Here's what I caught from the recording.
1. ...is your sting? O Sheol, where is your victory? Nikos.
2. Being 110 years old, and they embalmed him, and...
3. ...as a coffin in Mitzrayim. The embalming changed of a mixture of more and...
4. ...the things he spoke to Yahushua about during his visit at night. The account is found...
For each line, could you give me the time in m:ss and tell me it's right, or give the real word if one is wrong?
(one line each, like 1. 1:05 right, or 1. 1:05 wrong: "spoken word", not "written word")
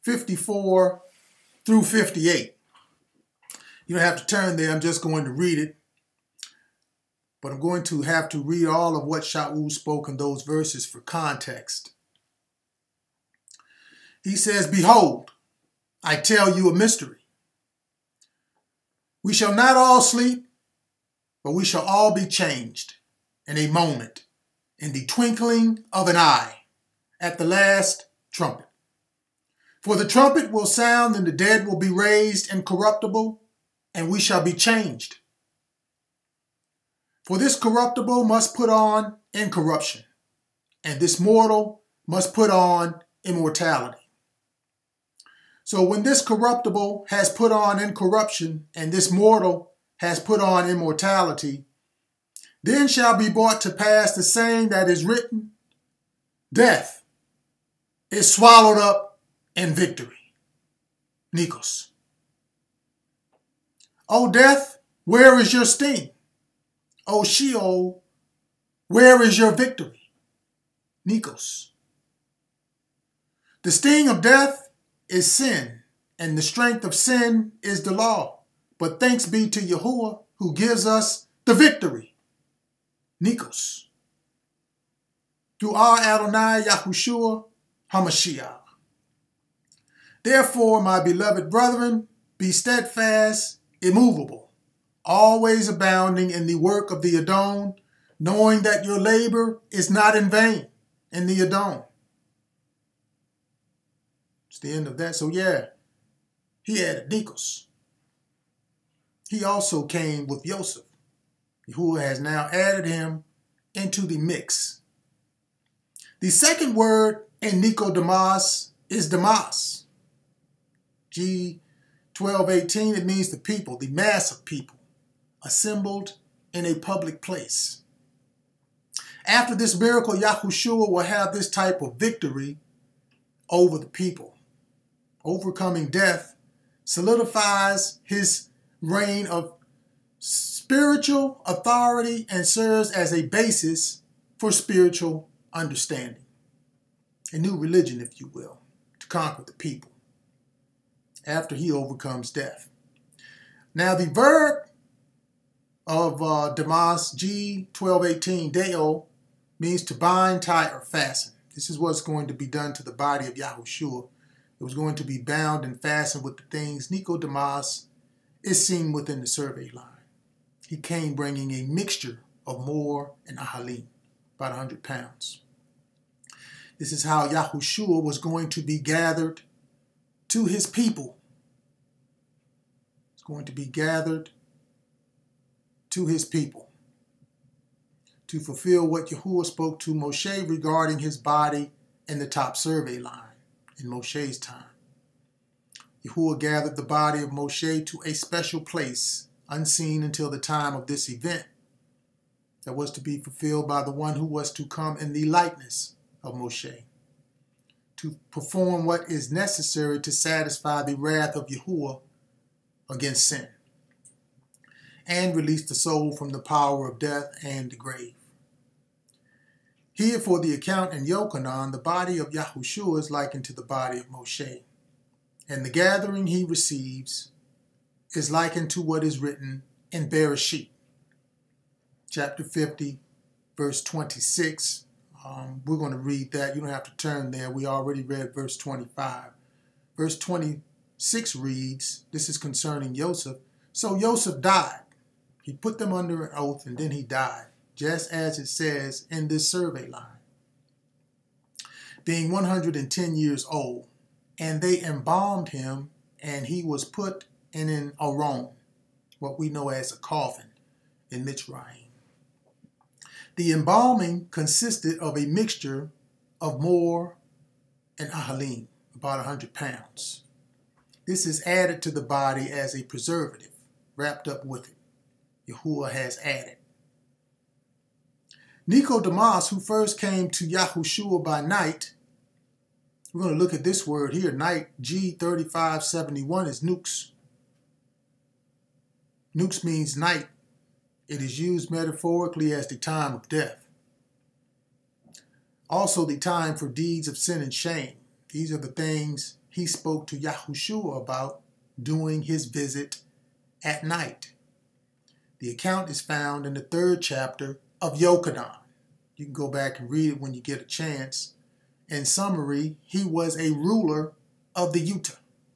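1. 1:05 right
2. 4:12 right
3. 4:19 wrong: "consisted", not "changed"
4. 4:58 right.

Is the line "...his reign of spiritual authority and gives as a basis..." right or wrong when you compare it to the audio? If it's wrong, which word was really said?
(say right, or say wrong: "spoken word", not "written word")
wrong: "serves", not "gives".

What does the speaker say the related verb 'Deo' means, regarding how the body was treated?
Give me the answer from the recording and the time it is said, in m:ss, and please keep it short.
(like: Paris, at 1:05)
to bind, tie, or fasten, at 2:39.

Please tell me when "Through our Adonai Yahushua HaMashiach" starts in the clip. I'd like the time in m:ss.
1:25.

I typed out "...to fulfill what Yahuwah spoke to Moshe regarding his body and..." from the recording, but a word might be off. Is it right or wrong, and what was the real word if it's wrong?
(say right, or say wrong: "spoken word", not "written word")
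right.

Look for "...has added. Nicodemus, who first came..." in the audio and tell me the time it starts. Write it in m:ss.
4:35.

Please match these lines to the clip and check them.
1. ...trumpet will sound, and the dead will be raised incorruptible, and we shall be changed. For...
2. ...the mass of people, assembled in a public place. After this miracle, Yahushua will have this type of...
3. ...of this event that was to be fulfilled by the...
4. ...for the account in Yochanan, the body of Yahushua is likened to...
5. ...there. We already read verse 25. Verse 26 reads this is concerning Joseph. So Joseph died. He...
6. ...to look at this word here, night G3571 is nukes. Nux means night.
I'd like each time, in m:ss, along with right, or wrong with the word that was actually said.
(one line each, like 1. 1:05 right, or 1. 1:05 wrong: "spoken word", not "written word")
1. 0:30 right
2. 2:03 right
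3. 3:20 right
4. 3:40 right
5. 3:57 right
6. 4:43 right.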